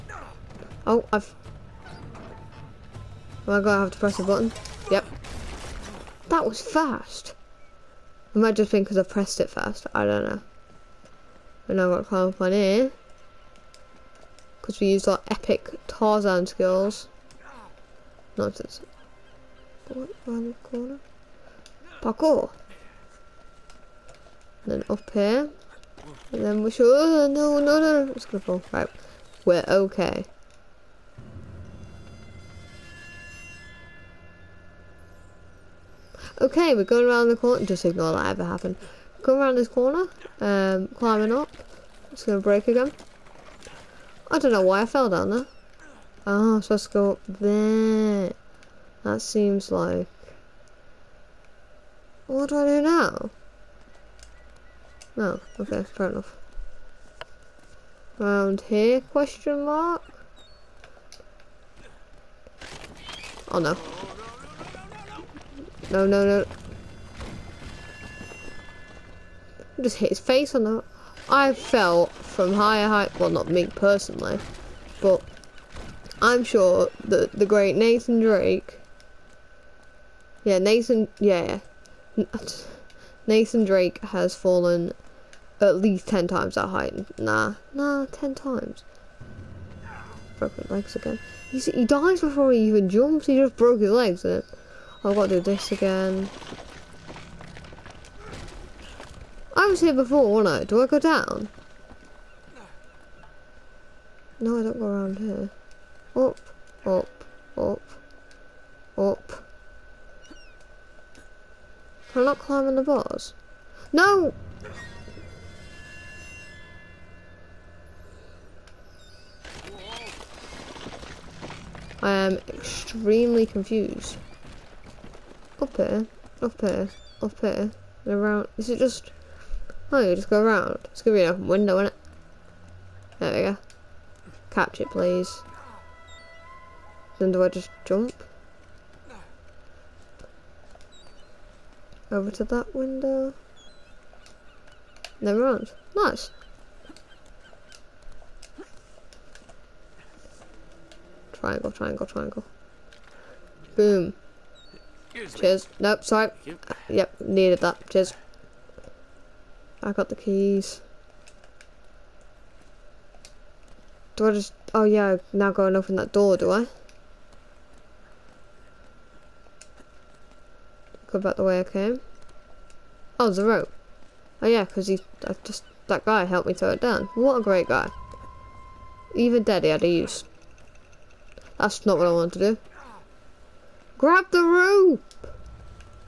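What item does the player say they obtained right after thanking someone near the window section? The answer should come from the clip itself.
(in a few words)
The keys.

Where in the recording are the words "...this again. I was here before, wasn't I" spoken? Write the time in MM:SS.
01:35.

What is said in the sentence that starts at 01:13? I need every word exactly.
Well, not me personally, but I'm sure that the great Nathan Drake.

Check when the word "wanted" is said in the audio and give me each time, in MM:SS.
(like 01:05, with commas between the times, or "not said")
03:02.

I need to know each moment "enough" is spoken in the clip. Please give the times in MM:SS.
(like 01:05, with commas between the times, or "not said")
00:56.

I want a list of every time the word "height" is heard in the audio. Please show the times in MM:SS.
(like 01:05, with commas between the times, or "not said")
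01:12, 01:26.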